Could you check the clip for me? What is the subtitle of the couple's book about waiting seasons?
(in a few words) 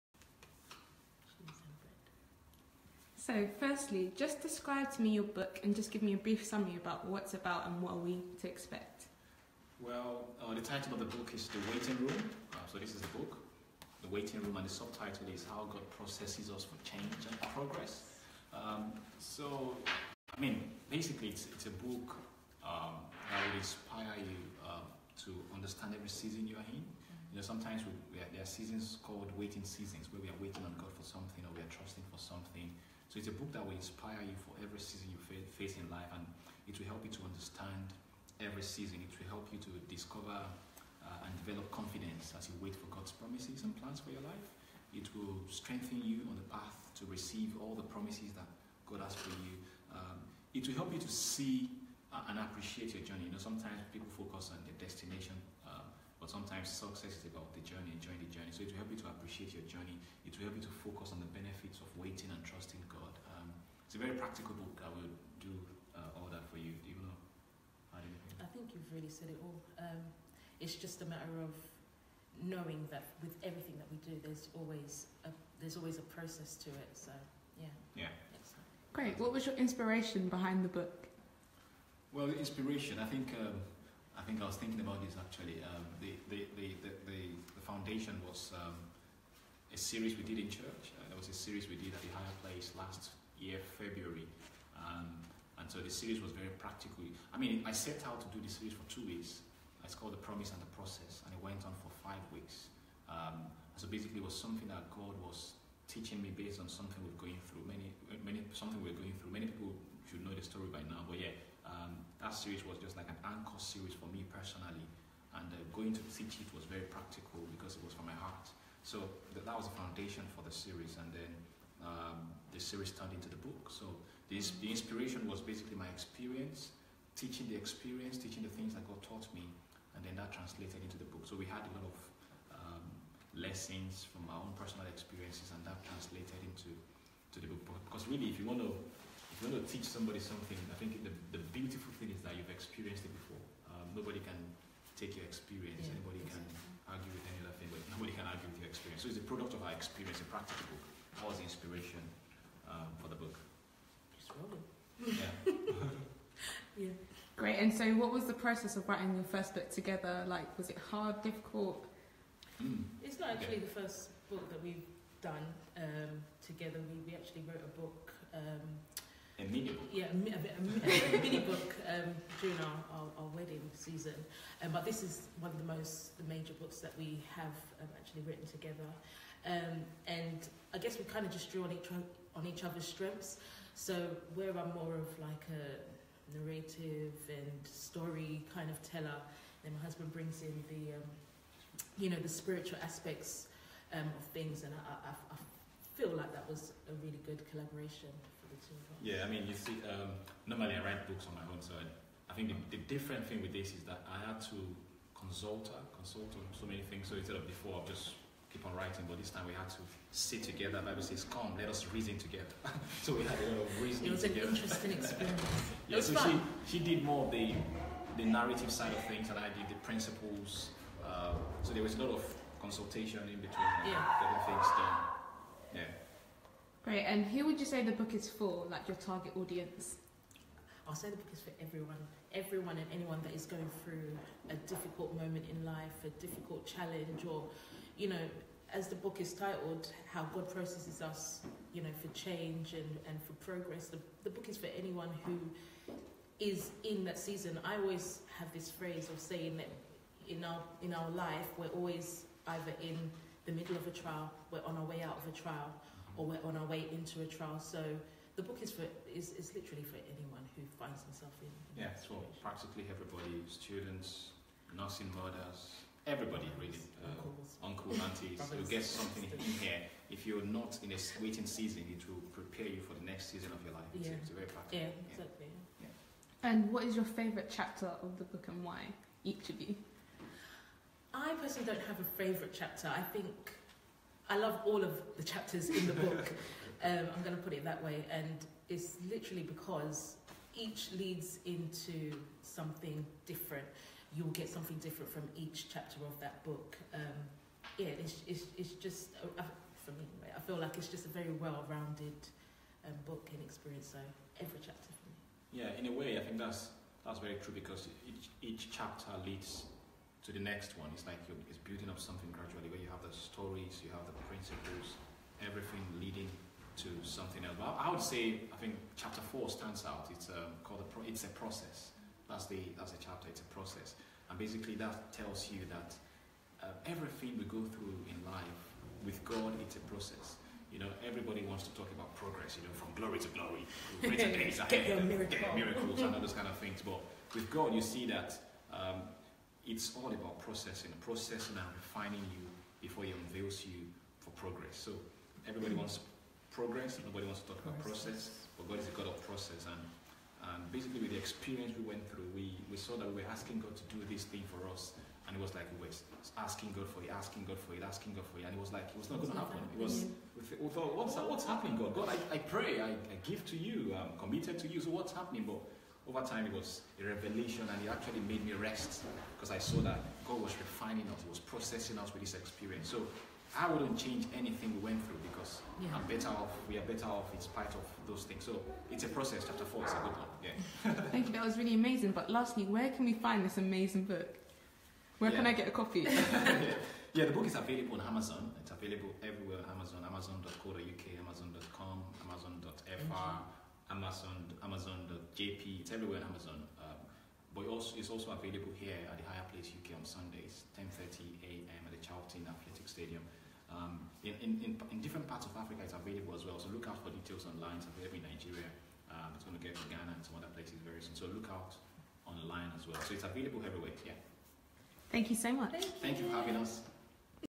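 How God Processes Us for Change and Progress.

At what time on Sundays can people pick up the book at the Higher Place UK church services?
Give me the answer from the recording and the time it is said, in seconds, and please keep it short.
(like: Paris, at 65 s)
10:30 a.m., at 400 s.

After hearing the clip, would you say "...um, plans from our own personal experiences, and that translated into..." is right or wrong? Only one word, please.
wrong.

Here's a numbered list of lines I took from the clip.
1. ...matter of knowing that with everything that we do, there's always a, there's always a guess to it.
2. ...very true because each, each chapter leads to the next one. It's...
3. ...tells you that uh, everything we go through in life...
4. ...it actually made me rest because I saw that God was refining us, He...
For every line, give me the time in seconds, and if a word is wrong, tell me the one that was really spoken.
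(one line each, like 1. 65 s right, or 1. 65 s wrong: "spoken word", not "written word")
1. 71 s wrong: "process", not "guess"
2. 307 s right
3. 325 s right
4. 367 s right.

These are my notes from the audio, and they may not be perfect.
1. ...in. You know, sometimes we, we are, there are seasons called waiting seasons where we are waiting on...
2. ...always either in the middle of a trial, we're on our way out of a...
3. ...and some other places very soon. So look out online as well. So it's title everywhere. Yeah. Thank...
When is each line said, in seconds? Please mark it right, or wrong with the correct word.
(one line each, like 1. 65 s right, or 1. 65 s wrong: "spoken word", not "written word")
1. 26 s right
2. 251 s right
3. 410 s wrong: "available", not "title".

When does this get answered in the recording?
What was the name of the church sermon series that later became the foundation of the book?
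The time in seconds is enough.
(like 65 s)
100 s.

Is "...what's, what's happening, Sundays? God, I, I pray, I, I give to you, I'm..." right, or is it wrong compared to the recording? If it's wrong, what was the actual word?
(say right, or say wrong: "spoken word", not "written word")
wrong: "God", not "Sundays".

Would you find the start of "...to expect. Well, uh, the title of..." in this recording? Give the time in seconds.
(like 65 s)
8 s.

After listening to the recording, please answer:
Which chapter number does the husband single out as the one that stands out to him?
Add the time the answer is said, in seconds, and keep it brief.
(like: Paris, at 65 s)
4, at 318 s.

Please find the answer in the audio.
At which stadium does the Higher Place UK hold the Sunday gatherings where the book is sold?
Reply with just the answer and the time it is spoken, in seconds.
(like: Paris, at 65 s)
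Charlton Athletic Stadium, at 401 s.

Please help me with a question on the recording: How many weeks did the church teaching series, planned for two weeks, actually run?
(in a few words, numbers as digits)
5.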